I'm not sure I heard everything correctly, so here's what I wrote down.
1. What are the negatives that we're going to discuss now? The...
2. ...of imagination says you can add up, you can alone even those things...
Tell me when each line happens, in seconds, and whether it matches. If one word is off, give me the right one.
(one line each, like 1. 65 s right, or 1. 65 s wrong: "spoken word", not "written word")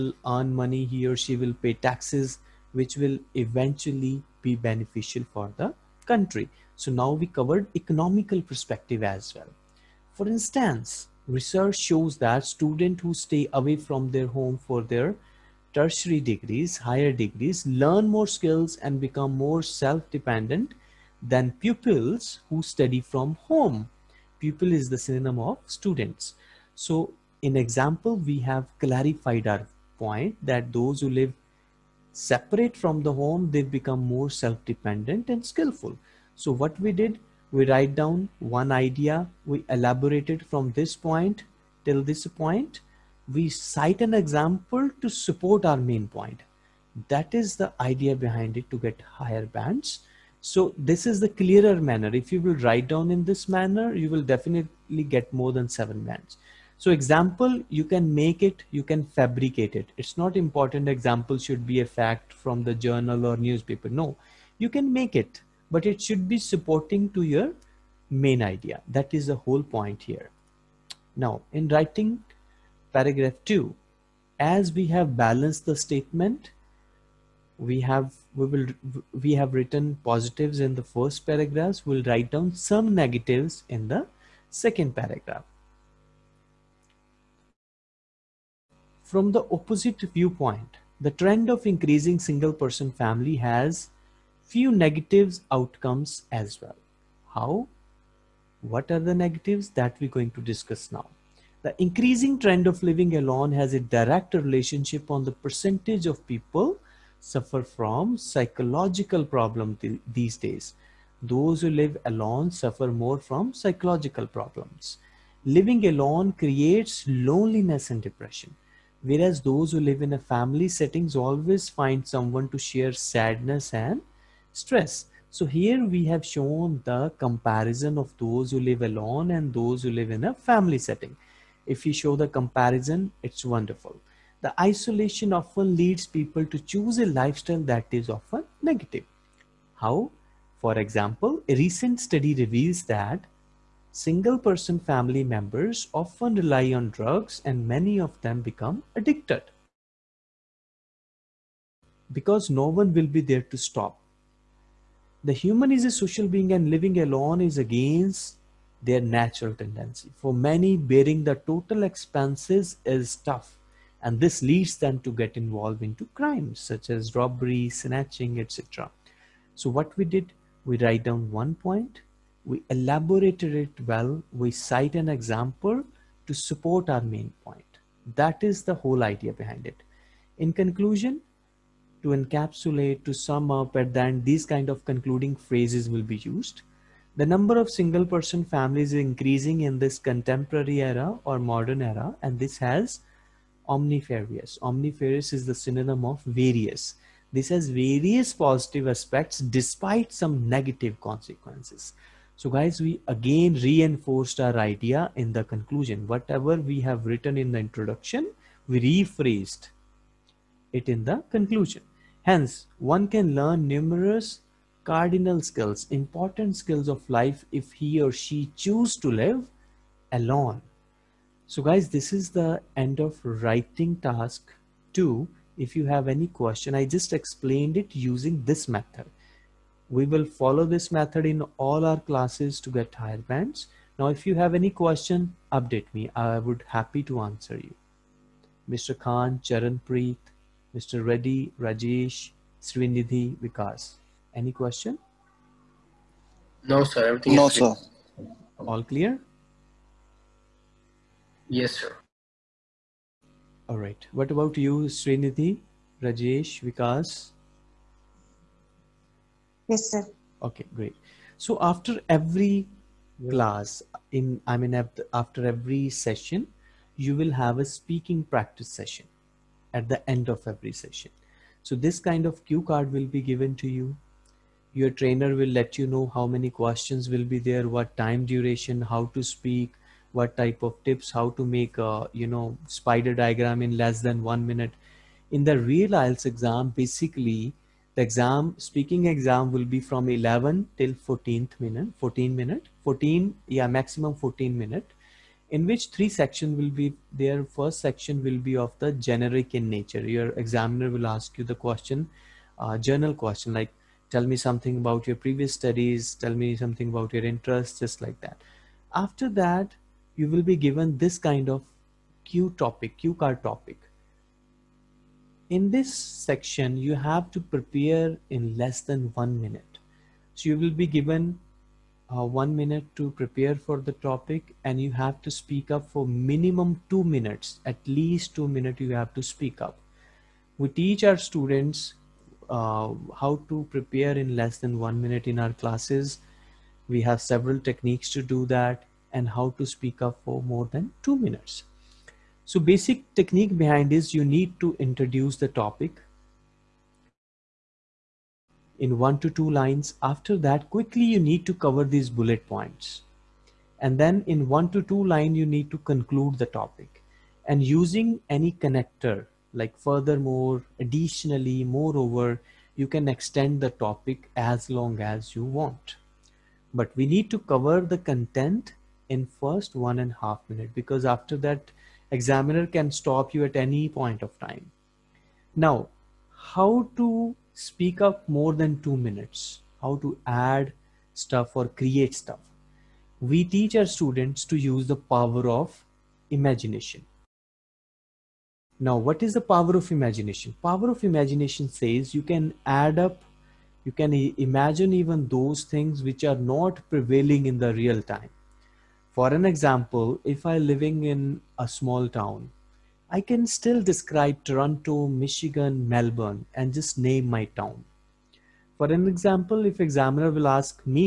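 1. 98 s right
2. 390 s wrong: "imagine", not "alone".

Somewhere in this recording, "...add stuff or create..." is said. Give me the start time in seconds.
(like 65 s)
380 s.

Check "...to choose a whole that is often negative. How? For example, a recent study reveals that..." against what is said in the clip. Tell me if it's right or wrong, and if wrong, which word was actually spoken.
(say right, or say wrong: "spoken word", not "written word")
wrong: "lifestyle", not "whole".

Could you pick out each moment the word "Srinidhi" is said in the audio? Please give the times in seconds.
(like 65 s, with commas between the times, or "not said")
242 s, 254 s.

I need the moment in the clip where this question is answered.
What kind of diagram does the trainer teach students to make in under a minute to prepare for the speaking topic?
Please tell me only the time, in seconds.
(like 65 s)
282 s.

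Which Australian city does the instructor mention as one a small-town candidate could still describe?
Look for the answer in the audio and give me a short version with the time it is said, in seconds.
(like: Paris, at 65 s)
Melbourne, at 405 s.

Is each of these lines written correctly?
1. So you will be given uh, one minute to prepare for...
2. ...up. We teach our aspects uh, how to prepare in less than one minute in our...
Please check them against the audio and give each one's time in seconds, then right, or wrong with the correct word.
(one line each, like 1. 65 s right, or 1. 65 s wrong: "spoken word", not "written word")
1. 320 s right
2. 329 s wrong: "students", not "aspects".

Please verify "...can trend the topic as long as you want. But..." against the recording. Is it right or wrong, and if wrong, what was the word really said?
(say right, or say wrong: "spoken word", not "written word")
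wrong: "extend", not "trend".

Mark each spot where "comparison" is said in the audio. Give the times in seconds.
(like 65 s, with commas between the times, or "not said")
127 s, 132 s.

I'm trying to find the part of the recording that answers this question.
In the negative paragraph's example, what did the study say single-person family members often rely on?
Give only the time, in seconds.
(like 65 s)
146 s.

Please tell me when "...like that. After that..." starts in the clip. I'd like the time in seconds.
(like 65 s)
308 s.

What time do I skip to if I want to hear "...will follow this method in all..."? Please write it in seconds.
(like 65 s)
230 s.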